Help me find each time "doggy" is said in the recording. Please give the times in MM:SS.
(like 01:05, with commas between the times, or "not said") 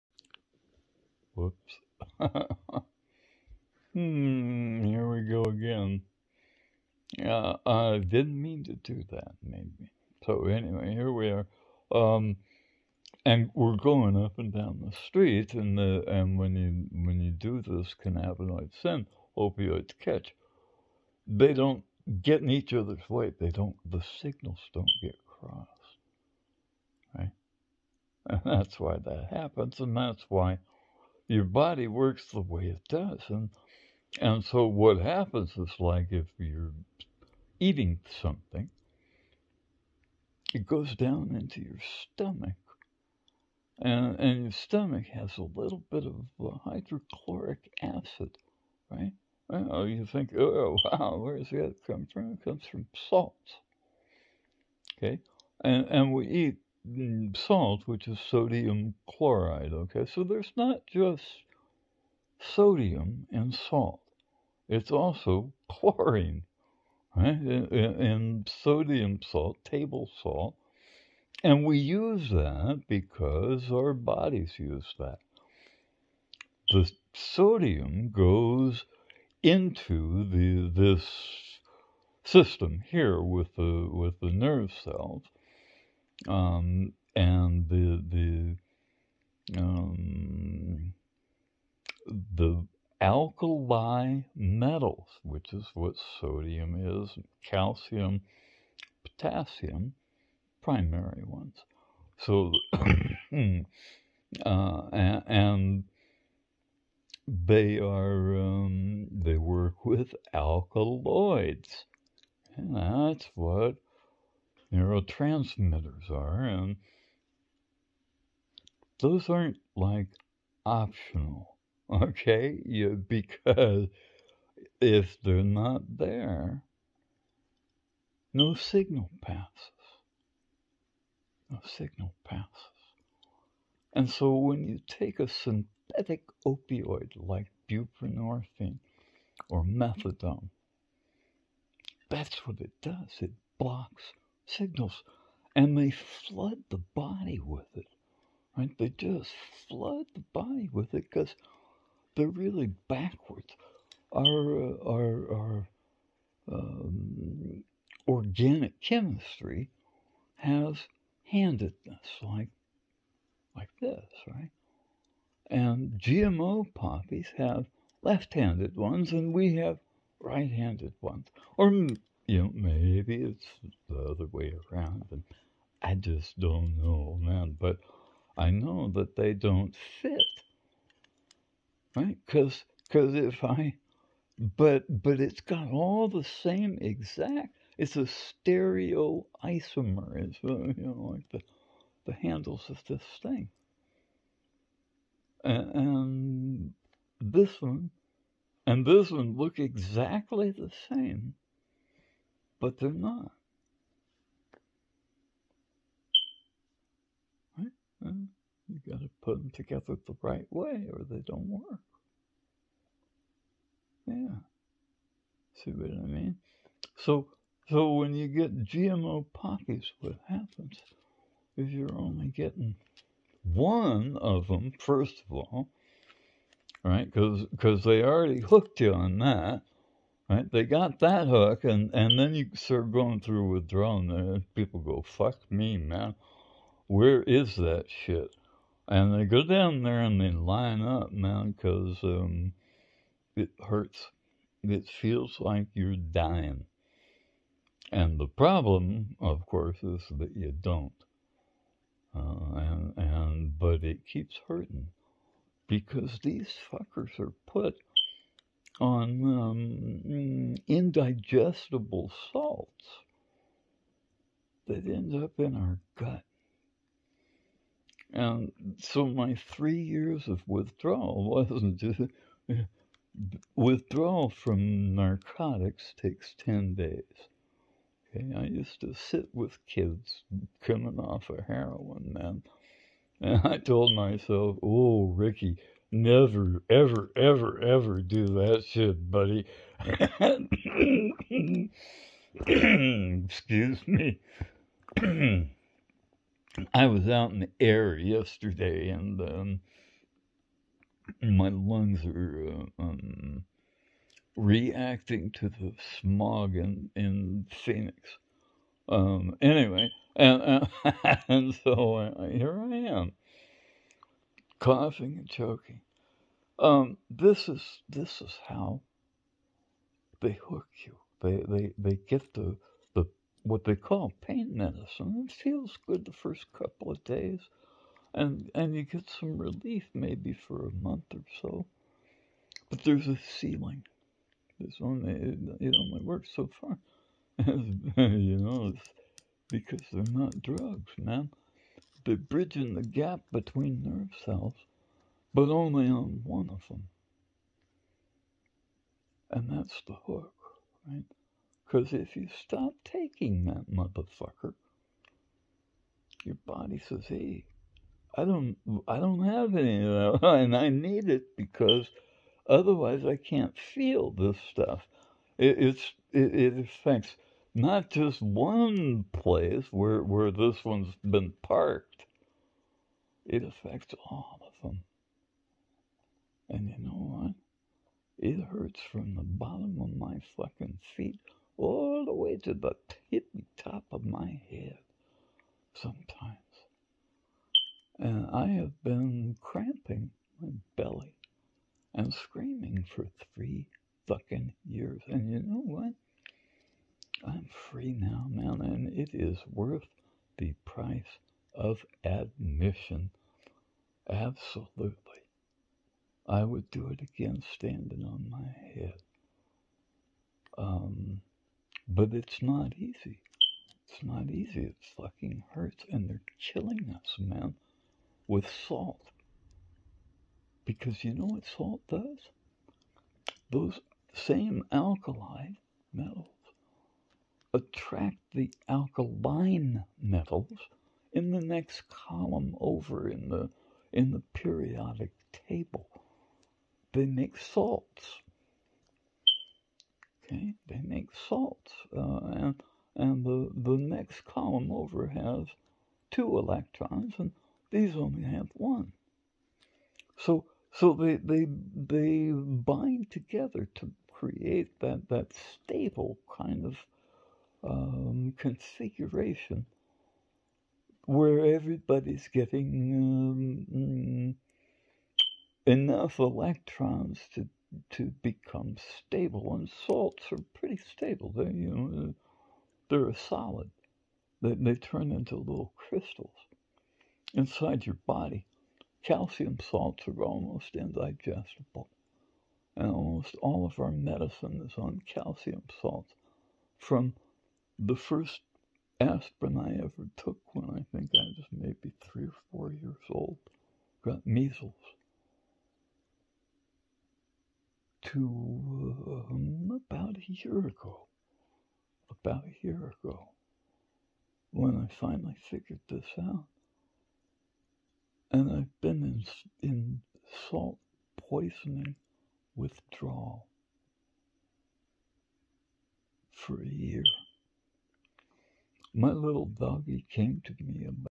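08:39.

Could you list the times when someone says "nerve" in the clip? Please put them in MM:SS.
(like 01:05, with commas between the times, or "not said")
01:24, 05:43.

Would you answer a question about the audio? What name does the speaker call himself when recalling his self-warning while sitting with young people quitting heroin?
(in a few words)
Ricky.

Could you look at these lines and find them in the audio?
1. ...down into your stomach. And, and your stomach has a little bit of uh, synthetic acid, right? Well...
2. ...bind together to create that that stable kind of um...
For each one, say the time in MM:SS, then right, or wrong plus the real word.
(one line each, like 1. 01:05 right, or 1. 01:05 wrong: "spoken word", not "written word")
1. 00:40 wrong: "hydrochloric", not "synthetic"
2. 07:32 right.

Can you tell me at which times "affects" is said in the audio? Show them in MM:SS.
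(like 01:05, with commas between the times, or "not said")
06:06, 06:13.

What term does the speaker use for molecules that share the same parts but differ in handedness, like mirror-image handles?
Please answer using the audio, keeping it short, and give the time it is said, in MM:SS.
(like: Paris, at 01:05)
Stereo isomer, at 03:08.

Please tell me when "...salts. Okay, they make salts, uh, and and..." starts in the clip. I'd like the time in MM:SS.
07:17.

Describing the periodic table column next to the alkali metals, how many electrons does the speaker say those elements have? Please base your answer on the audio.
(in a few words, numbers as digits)
2.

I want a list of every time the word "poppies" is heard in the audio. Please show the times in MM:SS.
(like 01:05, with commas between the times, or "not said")
02:46, 03:39.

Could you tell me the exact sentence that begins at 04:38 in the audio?
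Okay, I used to sit with kids coming off of heroin, man.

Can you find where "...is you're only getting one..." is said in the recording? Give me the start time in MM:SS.
03:41.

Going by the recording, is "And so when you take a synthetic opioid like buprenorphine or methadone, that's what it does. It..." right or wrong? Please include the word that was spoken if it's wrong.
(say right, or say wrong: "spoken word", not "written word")
right.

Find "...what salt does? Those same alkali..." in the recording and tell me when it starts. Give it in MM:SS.
07:01.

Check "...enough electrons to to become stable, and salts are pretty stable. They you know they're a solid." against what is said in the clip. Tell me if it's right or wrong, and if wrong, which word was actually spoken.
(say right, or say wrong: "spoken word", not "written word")
right.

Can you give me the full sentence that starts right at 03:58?
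And they go down there and they line up, man, because um, it hurts.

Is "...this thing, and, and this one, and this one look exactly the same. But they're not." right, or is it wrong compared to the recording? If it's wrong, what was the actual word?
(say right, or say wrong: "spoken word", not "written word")
right.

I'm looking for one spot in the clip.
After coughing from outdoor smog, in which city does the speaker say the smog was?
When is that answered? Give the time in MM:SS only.
05:07.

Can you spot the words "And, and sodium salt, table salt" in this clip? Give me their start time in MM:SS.
01:07.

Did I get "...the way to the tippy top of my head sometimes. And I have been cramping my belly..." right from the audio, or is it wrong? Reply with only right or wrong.
right.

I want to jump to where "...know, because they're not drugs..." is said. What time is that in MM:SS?
05:38.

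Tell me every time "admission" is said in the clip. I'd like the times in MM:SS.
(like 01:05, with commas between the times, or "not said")
06:42.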